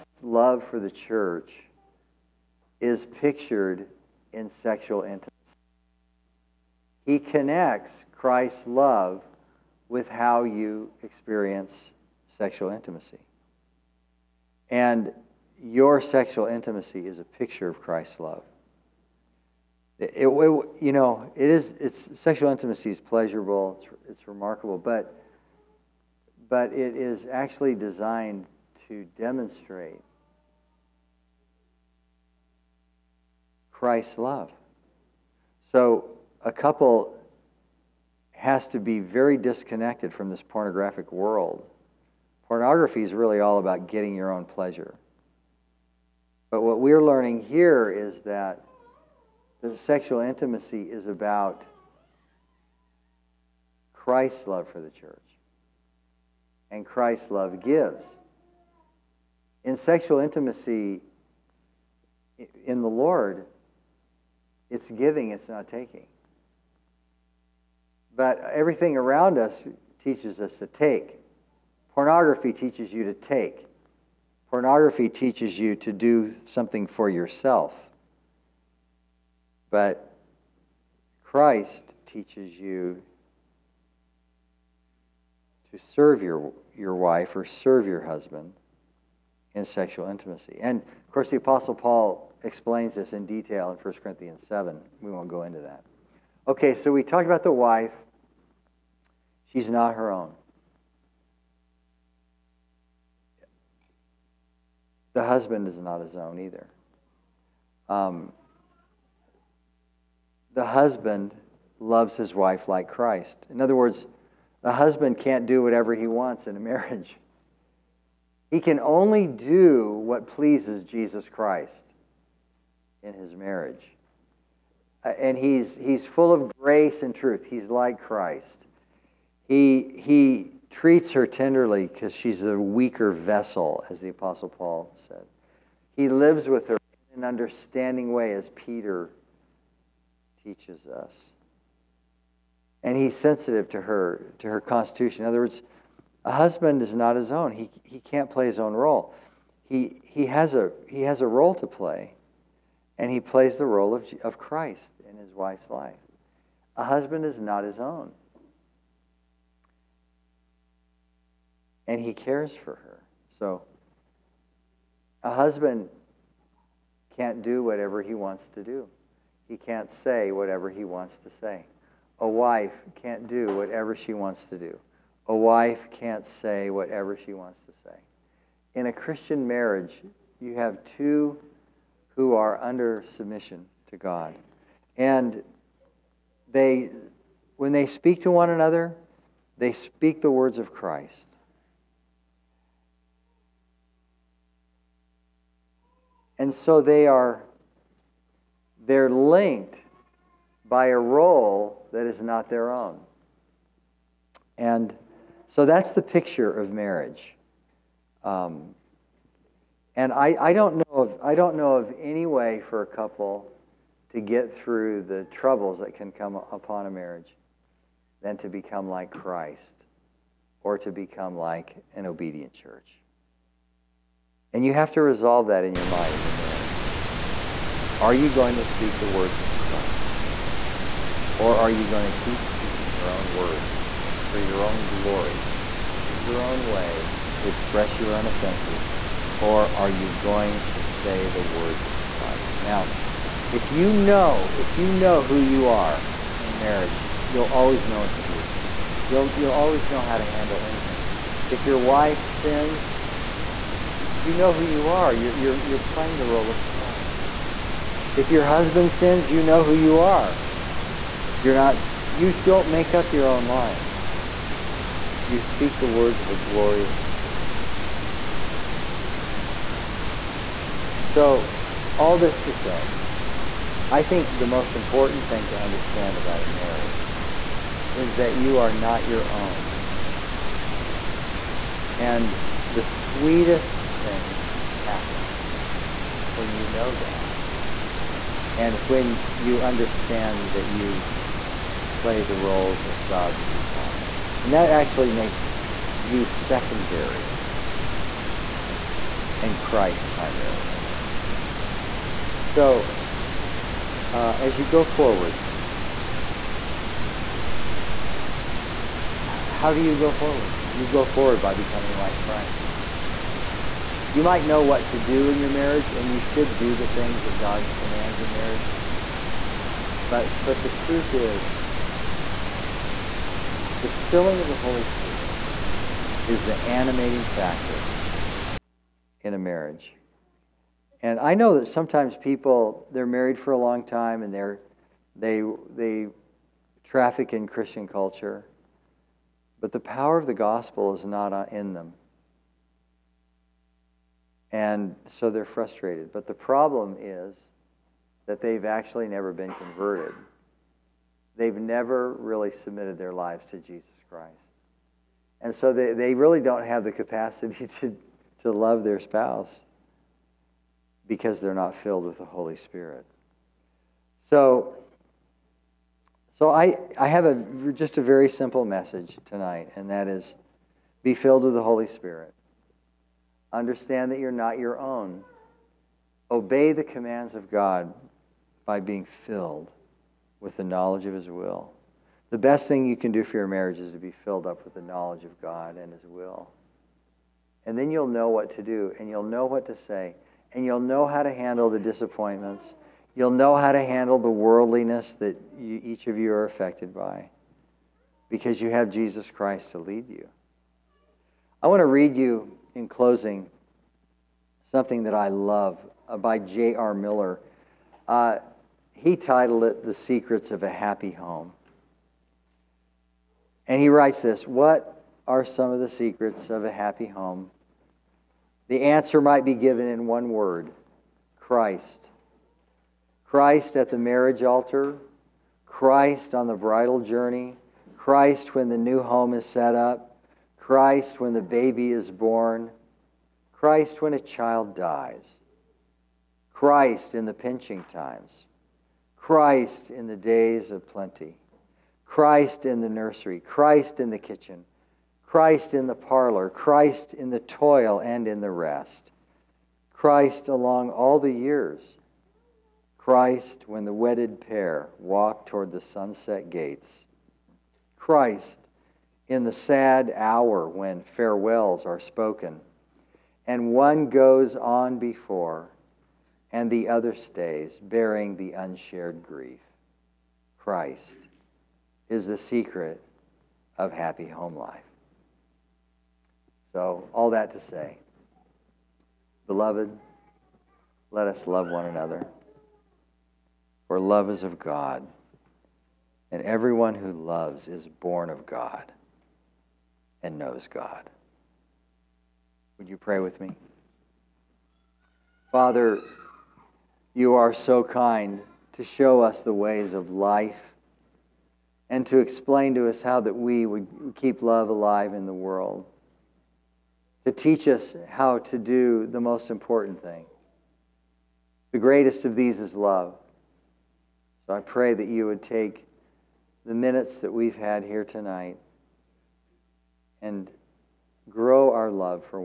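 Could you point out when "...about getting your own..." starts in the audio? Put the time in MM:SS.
00:43.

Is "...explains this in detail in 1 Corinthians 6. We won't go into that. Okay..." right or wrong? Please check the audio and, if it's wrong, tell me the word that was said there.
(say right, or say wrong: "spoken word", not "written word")
wrong: "7", not "6".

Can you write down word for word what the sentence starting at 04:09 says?
You'll, you'll always know how to handle anything.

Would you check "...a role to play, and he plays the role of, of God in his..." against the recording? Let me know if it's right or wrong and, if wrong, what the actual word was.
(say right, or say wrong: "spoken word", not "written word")
wrong: "Christ", not "God".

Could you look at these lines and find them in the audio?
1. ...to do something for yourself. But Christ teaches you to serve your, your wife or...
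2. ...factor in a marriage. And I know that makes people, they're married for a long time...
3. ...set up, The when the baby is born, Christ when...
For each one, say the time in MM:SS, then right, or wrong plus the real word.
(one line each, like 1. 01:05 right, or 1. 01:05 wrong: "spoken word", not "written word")
1. 01:15 right
2. 05:27 wrong: "sometimes", not "makes"
3. 07:09 wrong: "Christ", not "The".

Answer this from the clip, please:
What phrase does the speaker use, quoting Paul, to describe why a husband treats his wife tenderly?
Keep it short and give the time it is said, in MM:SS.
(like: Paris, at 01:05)
the weaker vessel, at 02:12.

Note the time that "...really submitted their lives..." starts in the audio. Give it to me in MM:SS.
05:52.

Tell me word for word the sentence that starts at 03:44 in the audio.
And you have to resolve that in your mind, in your marriage.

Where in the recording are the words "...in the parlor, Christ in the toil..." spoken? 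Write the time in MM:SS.
07:25.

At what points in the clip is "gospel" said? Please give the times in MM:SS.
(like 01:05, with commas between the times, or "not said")
05:40.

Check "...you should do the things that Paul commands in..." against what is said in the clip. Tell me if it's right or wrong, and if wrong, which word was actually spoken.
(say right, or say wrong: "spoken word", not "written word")
wrong: "God", not "Paul".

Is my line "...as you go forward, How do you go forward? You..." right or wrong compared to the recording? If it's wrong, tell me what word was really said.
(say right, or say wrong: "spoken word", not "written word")
right.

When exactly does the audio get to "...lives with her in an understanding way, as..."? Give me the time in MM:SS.
02:16.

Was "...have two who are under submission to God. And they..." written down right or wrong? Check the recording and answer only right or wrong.
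right.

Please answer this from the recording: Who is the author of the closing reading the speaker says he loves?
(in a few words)
J.R. Miller.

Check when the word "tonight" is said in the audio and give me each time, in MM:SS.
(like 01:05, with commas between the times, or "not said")
06:09, 08:38.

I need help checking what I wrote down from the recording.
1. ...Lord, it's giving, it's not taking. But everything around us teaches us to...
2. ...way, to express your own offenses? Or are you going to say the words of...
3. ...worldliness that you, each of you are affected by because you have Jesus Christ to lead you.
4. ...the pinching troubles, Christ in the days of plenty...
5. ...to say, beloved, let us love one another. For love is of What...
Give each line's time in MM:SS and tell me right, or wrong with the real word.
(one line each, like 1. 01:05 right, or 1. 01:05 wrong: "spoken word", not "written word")
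1. 01:02 right
2. 03:56 right
3. 06:34 right
4. 07:17 wrong: "times", not "troubles"
5. 07:57 wrong: "God", not "What".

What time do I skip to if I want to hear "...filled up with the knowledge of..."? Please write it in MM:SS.
06:24.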